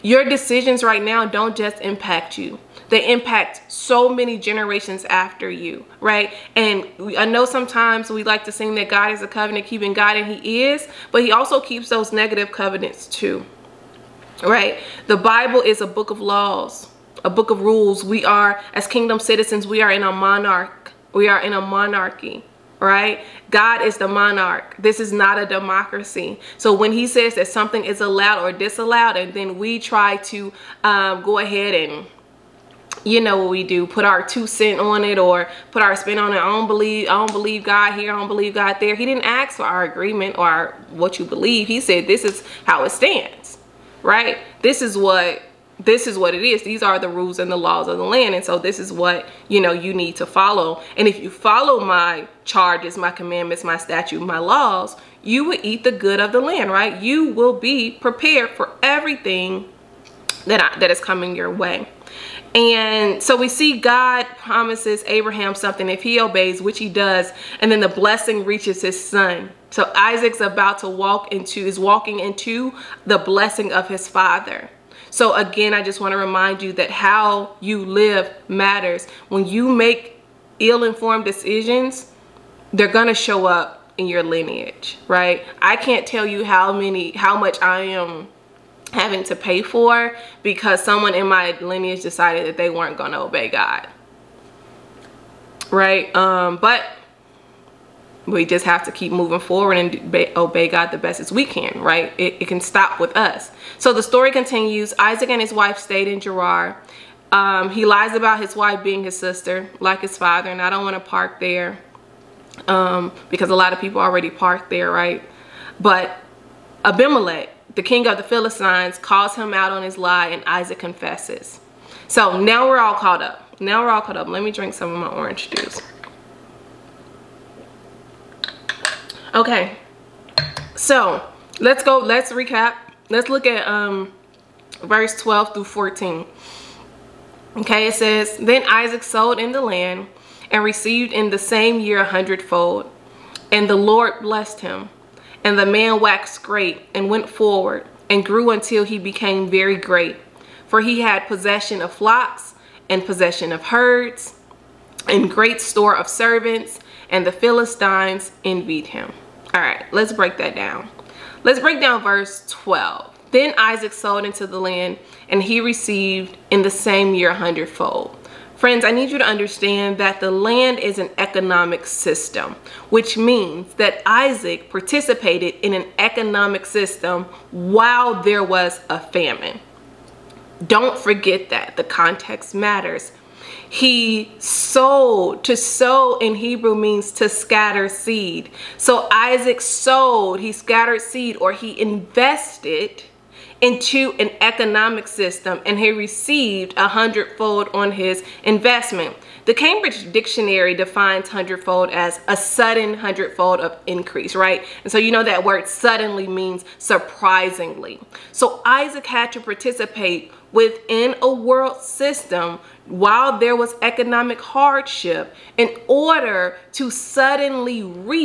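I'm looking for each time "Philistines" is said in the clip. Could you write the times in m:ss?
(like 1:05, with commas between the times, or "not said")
1:58, 2:37.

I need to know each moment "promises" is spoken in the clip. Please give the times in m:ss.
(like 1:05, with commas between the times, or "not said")
1:04.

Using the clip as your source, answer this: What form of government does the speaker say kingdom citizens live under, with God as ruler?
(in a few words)
A monarchy.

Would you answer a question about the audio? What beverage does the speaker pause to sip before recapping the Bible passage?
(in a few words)
Orange juice.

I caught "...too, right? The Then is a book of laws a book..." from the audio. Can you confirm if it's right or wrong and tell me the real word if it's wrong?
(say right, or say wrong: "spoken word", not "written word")
wrong: "Bible", not "Then".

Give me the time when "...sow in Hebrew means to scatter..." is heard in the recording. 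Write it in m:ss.
3:05.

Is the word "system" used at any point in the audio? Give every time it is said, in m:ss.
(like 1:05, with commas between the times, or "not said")
2:51, 2:56, 3:15, 3:31.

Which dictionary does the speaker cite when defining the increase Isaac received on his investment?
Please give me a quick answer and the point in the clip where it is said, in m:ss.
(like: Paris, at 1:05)
Cambridge Dictionary, at 3:19.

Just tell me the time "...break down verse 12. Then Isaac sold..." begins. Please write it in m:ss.
2:41.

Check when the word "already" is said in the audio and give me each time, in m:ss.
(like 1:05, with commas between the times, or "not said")
1:53.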